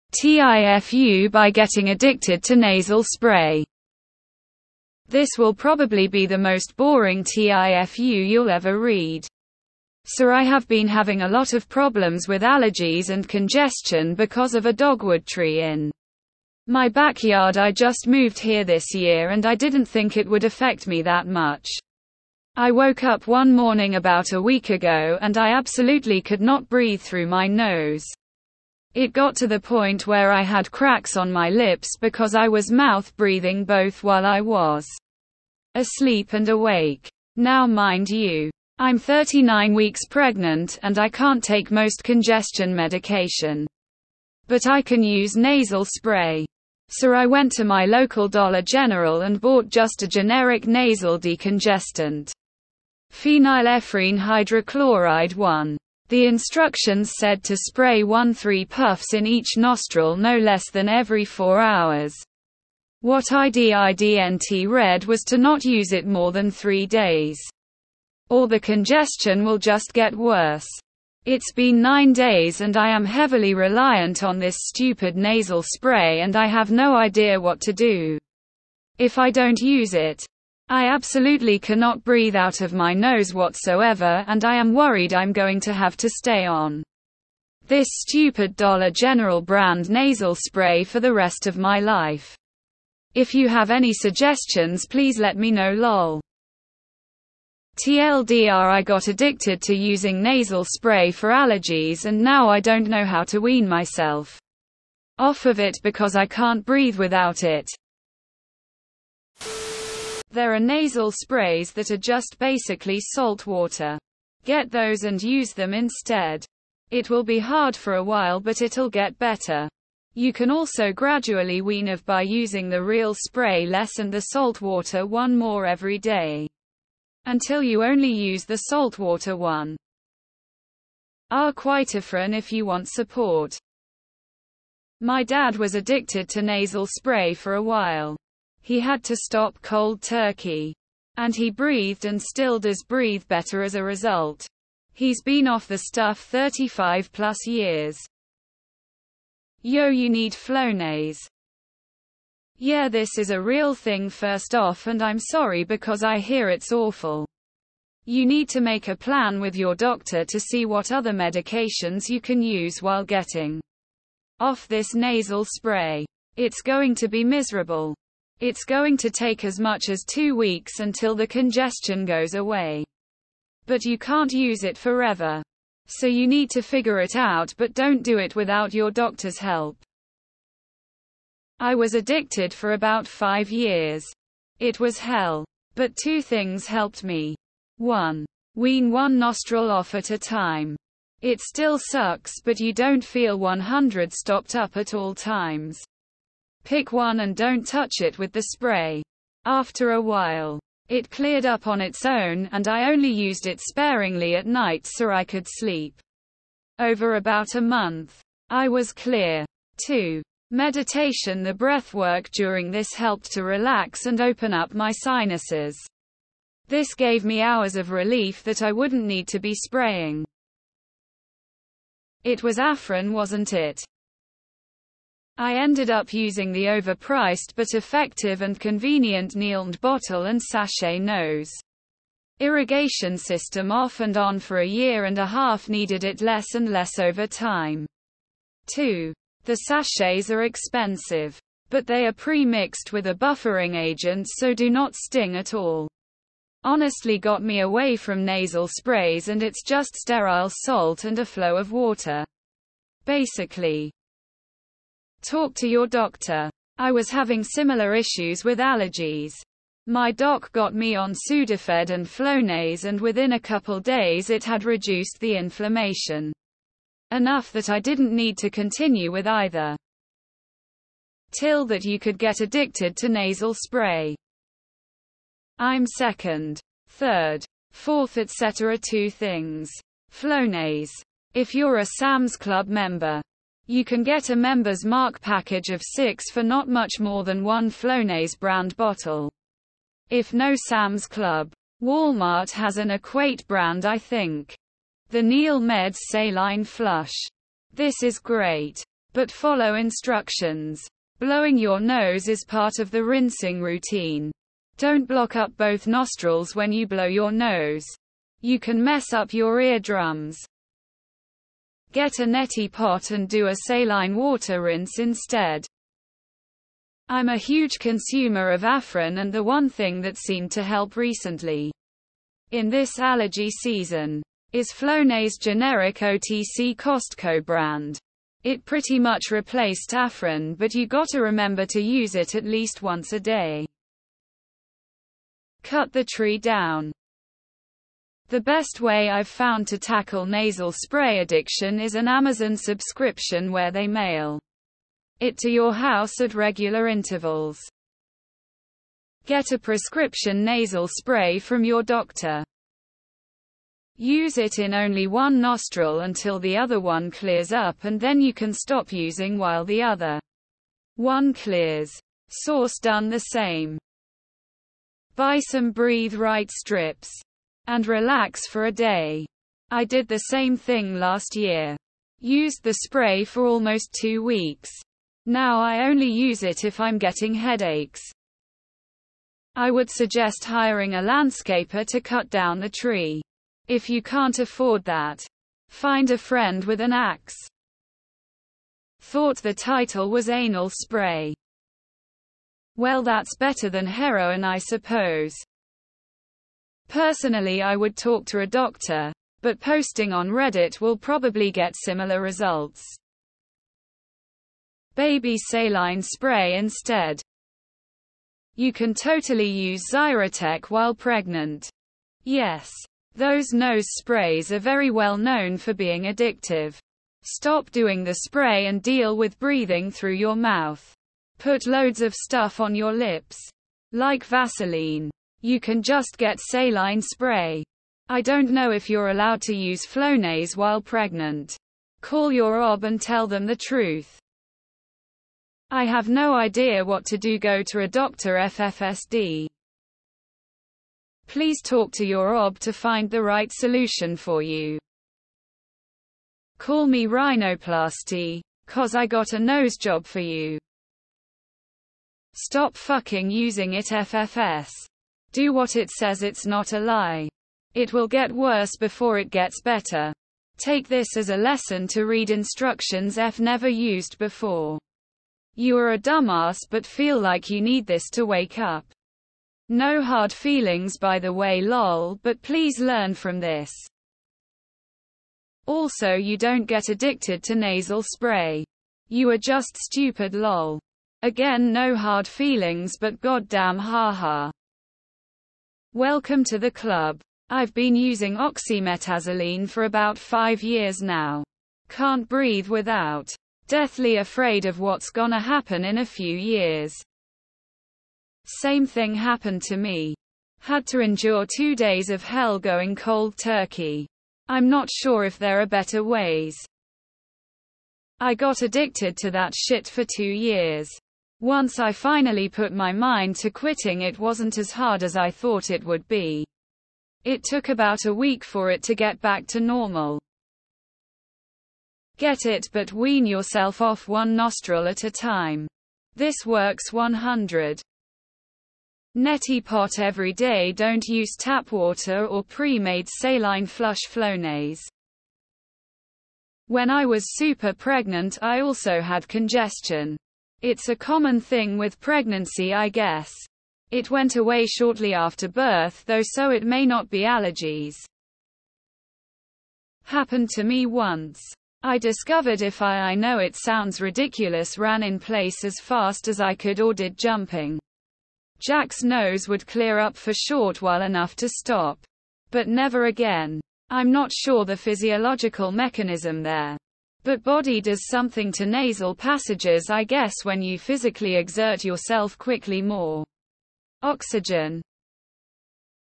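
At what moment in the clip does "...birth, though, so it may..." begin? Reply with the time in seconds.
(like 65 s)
545 s.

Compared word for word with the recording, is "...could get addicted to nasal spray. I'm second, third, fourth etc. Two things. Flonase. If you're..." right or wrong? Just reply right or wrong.
right.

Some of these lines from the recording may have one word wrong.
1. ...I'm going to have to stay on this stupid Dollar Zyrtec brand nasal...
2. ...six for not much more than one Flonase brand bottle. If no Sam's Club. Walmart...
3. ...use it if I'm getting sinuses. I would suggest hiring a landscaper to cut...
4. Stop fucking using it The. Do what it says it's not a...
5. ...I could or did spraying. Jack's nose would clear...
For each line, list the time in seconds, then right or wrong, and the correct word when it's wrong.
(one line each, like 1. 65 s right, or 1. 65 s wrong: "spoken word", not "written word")
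1. 85 s wrong: "General", not "Zyrtec"
2. 285 s right
3. 376 s wrong: "headaches", not "sinuses"
4. 452 s wrong: "FFS", not "The"
5. 556 s wrong: "jumping", not "spraying".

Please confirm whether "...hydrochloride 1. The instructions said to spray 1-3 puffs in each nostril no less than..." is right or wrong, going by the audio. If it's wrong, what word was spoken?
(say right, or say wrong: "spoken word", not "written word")
right.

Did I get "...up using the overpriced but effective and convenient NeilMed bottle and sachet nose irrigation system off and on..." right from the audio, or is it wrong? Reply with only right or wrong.
right.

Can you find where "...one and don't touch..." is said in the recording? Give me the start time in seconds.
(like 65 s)
196 s.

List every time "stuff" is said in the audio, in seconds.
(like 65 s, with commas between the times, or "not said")
145 s, 422 s.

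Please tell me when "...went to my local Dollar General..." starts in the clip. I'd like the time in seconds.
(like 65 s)
47 s.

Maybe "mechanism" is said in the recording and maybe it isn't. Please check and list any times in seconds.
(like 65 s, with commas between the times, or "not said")
565 s.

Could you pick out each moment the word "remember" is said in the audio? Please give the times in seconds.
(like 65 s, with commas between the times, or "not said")
331 s.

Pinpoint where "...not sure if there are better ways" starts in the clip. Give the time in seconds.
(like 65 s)
504 s.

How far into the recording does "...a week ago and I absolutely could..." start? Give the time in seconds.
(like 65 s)
24 s.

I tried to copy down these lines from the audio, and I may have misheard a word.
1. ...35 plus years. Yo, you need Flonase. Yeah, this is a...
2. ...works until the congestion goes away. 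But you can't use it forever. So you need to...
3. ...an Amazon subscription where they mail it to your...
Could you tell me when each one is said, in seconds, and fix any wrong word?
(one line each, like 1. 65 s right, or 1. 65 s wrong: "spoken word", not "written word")
1. 146 s right
2. 170 s wrong: "weeks", not "works"
3. 341 s right.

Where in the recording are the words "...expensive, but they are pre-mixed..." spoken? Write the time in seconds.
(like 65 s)
240 s.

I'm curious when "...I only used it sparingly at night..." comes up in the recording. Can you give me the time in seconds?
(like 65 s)
202 s.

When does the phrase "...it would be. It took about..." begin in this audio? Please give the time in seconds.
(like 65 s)
515 s.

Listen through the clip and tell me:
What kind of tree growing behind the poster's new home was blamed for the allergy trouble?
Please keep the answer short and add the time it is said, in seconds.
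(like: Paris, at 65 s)
Dogwood, at 14 s.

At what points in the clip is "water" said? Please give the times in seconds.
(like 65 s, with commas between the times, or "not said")
113 s, 124 s, 128 s, 251 s, 314 s, 531 s.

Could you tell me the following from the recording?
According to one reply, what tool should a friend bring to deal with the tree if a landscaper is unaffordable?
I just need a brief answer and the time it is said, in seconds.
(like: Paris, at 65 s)
Axe, at 386 s.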